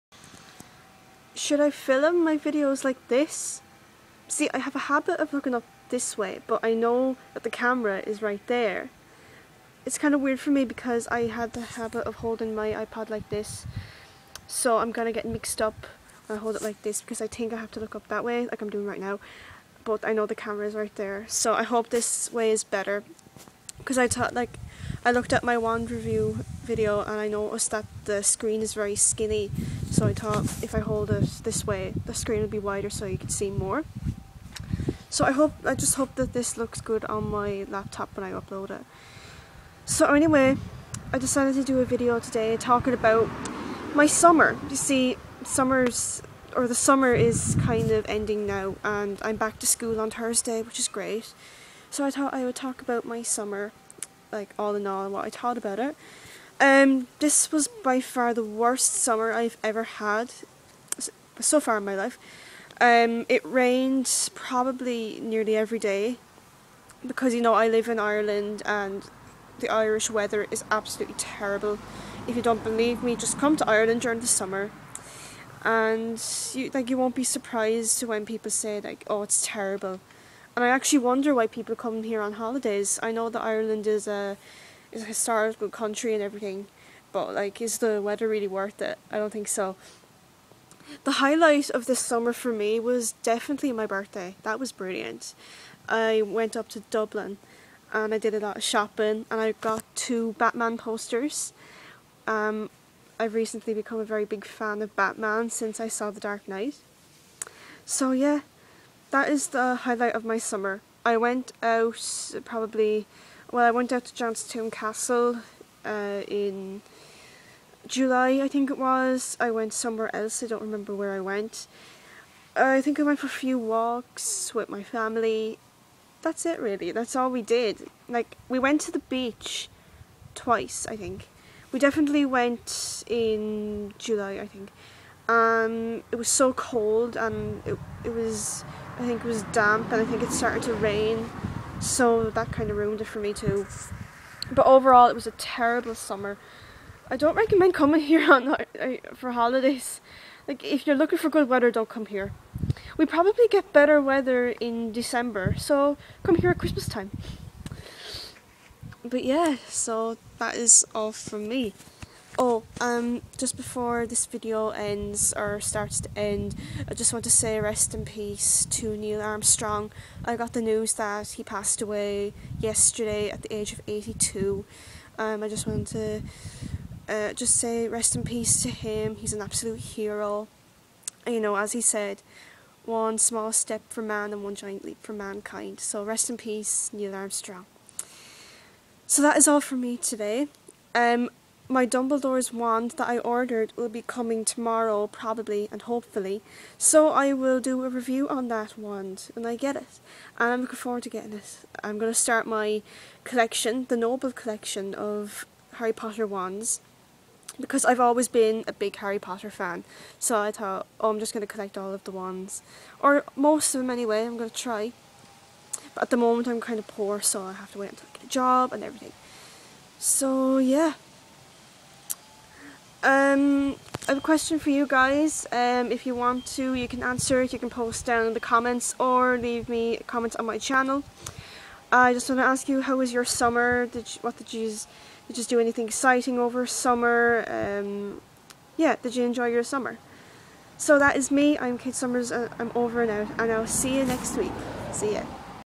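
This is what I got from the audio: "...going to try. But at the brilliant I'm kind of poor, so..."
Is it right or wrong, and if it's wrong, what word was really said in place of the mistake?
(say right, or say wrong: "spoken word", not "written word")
wrong: "moment", not "brilliant".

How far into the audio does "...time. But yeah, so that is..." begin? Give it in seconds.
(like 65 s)
156 s.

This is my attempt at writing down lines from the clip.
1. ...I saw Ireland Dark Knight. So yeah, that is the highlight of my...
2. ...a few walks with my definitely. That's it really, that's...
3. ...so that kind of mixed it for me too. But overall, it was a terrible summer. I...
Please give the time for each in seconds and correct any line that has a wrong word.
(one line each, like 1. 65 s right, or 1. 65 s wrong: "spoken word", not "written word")
1. 105 s wrong: "The", not "Ireland"
2. 123 s wrong: "family", not "definitely"
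3. 141 s wrong: "ruined", not "mixed".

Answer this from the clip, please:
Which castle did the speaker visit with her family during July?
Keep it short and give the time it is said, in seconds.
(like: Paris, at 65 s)
Johnstown Castle, at 114 s.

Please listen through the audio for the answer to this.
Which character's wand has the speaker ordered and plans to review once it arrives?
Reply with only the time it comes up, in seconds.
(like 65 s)
191 s.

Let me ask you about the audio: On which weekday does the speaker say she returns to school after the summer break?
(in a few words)
Thursday.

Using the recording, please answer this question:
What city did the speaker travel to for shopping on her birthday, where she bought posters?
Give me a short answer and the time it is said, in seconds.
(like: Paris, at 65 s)
Dublin, at 96 s.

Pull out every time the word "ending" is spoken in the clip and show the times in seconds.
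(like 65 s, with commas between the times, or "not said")
48 s.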